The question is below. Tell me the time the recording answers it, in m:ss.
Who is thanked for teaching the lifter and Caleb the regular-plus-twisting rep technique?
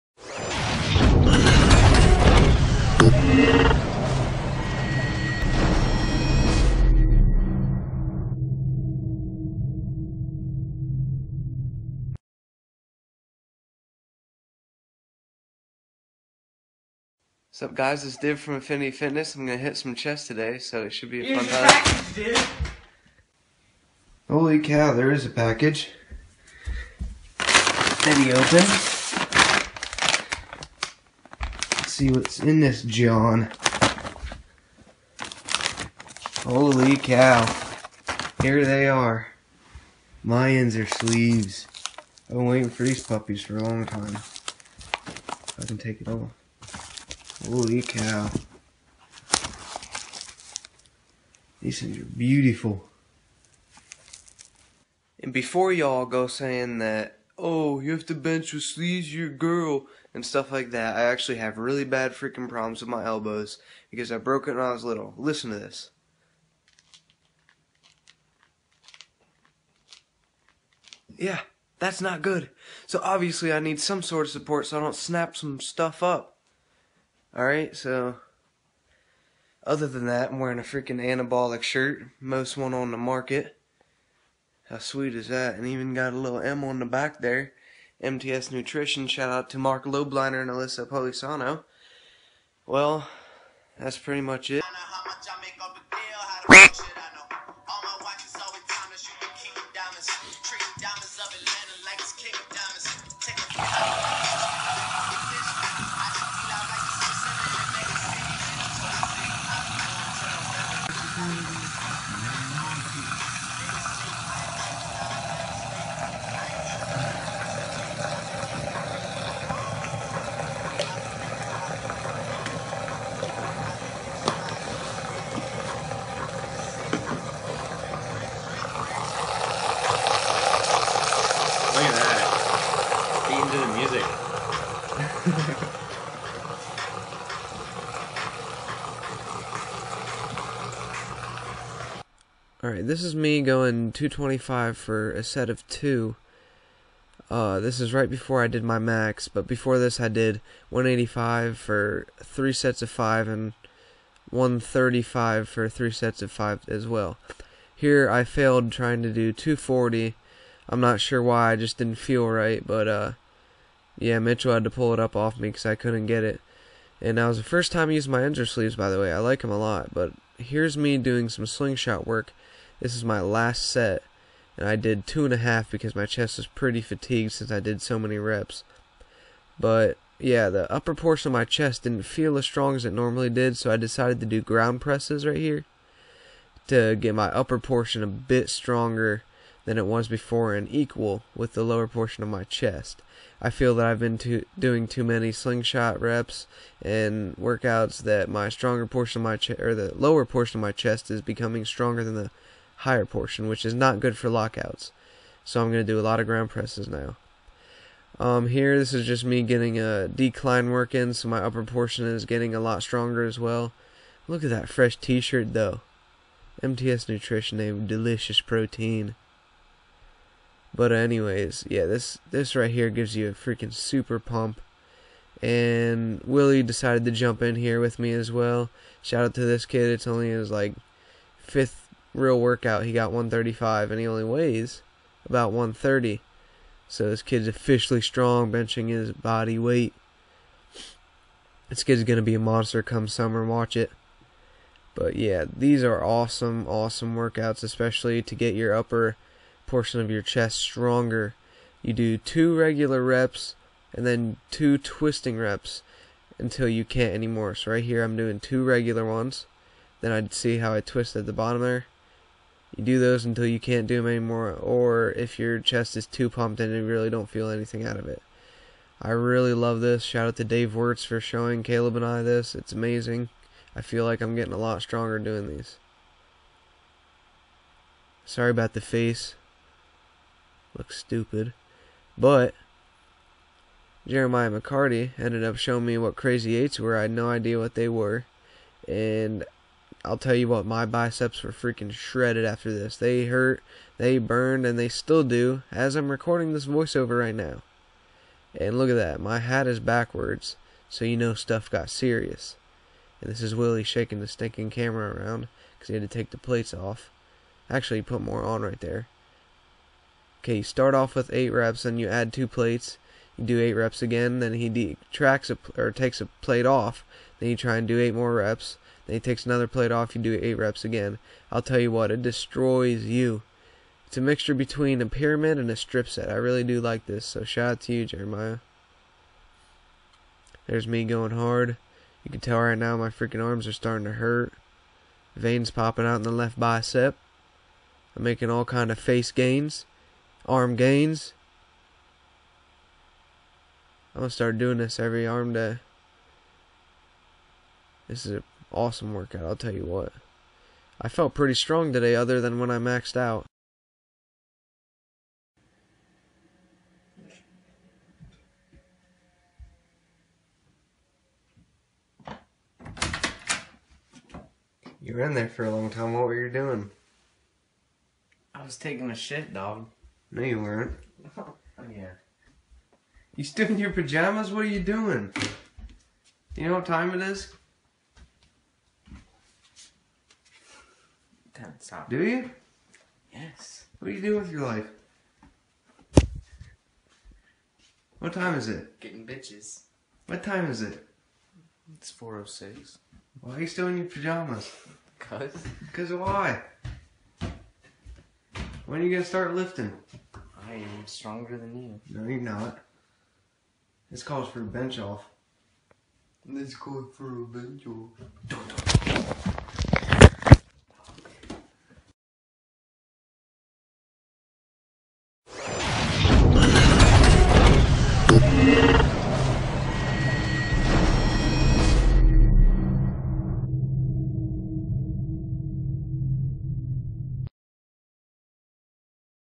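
4:30.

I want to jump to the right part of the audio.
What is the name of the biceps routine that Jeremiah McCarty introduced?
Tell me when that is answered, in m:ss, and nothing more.
4:46.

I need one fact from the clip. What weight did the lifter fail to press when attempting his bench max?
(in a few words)
240.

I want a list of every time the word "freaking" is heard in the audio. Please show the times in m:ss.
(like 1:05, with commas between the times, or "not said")
1:02, 1:20, 3:43, 4:51, 5:33.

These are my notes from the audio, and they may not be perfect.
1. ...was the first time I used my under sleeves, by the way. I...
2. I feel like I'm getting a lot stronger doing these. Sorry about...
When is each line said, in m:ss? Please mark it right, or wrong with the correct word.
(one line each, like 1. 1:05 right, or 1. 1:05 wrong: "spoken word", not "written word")
1. 2:47 right
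2. 4:33 right.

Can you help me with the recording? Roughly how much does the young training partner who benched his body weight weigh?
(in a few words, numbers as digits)
130.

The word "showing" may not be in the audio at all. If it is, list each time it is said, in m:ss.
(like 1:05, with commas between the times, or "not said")
4:31, 4:45.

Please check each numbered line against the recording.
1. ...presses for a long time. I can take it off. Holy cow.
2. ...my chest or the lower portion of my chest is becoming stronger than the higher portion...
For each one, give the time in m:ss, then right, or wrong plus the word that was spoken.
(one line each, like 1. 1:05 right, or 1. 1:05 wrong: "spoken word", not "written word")
1. 0:43 wrong: "puppies", not "presses"
2. 3:19 right.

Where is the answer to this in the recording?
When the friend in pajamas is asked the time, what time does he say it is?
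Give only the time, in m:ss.
6:32.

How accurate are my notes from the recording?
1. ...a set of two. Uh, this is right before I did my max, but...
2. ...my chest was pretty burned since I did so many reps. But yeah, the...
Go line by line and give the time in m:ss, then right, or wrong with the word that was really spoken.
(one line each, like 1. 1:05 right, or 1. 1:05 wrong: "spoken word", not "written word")
1. 2:25 right
2. 2:55 wrong: "fatigued", not "burned".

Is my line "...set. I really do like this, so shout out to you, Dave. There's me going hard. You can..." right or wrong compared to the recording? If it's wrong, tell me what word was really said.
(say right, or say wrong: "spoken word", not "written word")
wrong: "Jeremiah", not "Dave".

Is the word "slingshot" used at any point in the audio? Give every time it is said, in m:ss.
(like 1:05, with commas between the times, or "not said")
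2:51, 3:15.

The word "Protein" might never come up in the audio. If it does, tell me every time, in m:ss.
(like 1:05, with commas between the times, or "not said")
3:38.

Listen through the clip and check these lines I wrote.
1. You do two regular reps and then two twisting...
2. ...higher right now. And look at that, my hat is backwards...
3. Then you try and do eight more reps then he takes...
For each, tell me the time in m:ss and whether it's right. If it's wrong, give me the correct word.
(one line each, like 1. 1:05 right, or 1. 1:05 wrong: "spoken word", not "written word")
1. 4:11 right
2. 4:56 wrong: "voiceover", not "higher"
3. 5:17 right.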